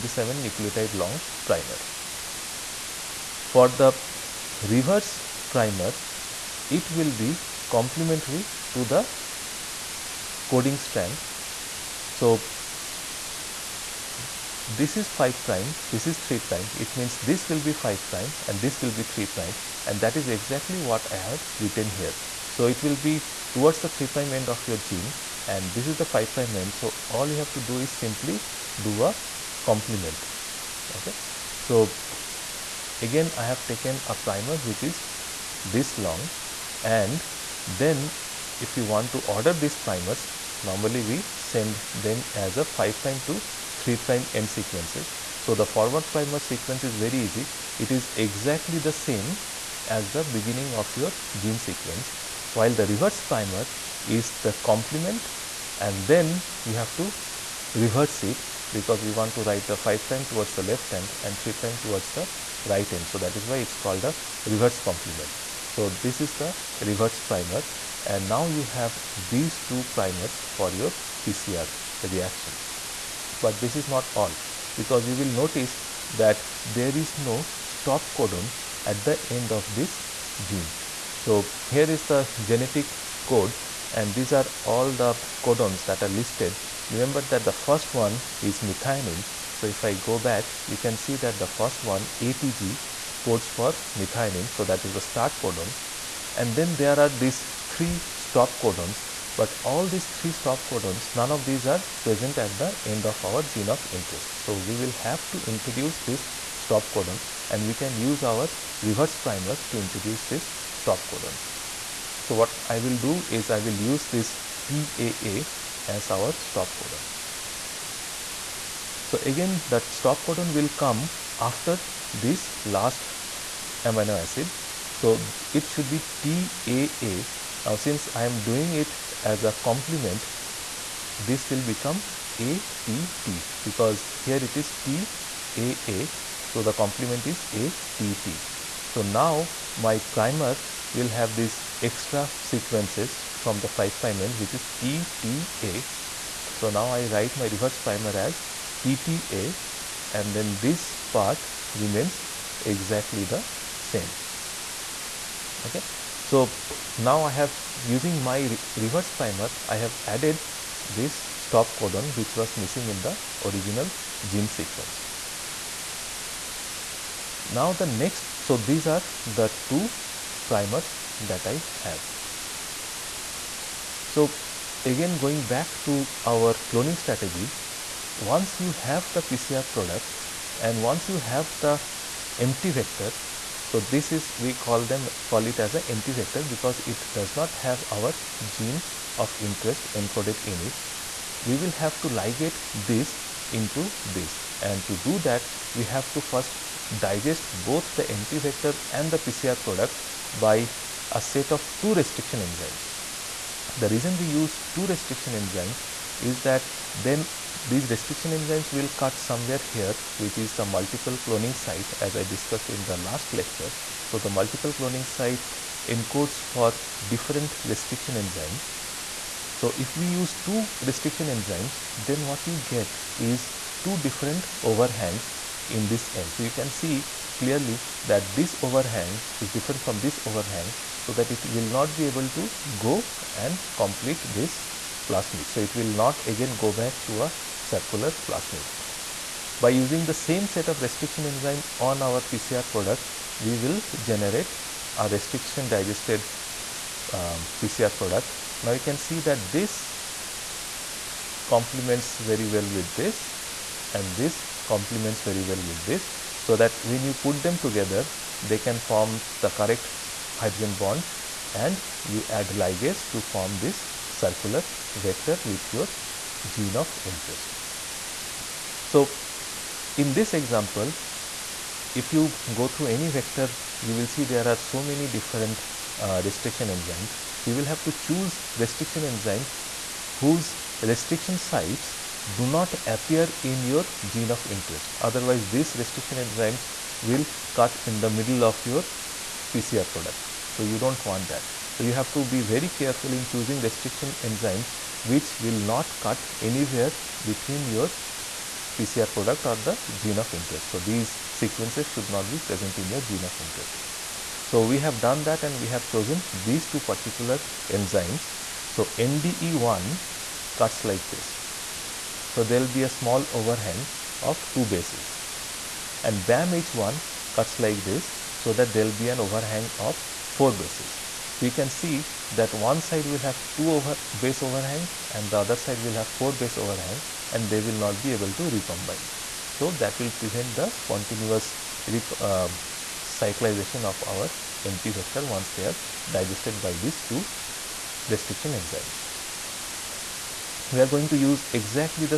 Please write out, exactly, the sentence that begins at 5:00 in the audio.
So, these sequences should not be present in your gene of interest.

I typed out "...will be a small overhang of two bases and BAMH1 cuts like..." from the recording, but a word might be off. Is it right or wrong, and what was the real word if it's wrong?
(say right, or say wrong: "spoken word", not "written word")
right.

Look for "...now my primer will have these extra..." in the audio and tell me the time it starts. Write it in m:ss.
2:19.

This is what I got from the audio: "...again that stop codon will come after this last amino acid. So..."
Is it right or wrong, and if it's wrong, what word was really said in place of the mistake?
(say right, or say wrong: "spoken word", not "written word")
right.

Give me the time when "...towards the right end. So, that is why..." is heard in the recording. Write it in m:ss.
1:01.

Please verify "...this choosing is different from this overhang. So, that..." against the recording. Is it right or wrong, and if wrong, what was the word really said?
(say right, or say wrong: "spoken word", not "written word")
wrong: "overhang", not "choosing".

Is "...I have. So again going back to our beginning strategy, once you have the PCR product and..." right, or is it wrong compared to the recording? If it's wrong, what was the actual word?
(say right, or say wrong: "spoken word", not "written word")
wrong: "cloning", not "beginning".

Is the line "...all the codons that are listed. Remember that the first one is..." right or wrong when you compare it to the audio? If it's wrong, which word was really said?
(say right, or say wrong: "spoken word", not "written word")
right.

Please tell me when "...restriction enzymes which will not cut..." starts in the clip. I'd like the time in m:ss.
4:53.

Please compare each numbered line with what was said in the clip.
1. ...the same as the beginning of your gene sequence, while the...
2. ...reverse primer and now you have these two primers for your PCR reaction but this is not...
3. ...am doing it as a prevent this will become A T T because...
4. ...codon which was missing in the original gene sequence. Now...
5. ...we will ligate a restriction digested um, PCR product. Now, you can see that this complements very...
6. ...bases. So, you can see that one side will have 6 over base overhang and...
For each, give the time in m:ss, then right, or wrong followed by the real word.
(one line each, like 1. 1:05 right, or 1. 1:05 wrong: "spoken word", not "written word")
1. 0:48 right
2. 1:06 right
3. 2:08 wrong: "complement", not "prevent"
4. 2:41 right
5. 4:03 wrong: "generate", not "ligate"
6. 5:20 wrong: "2", not "6".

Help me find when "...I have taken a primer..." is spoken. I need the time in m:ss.
0:33.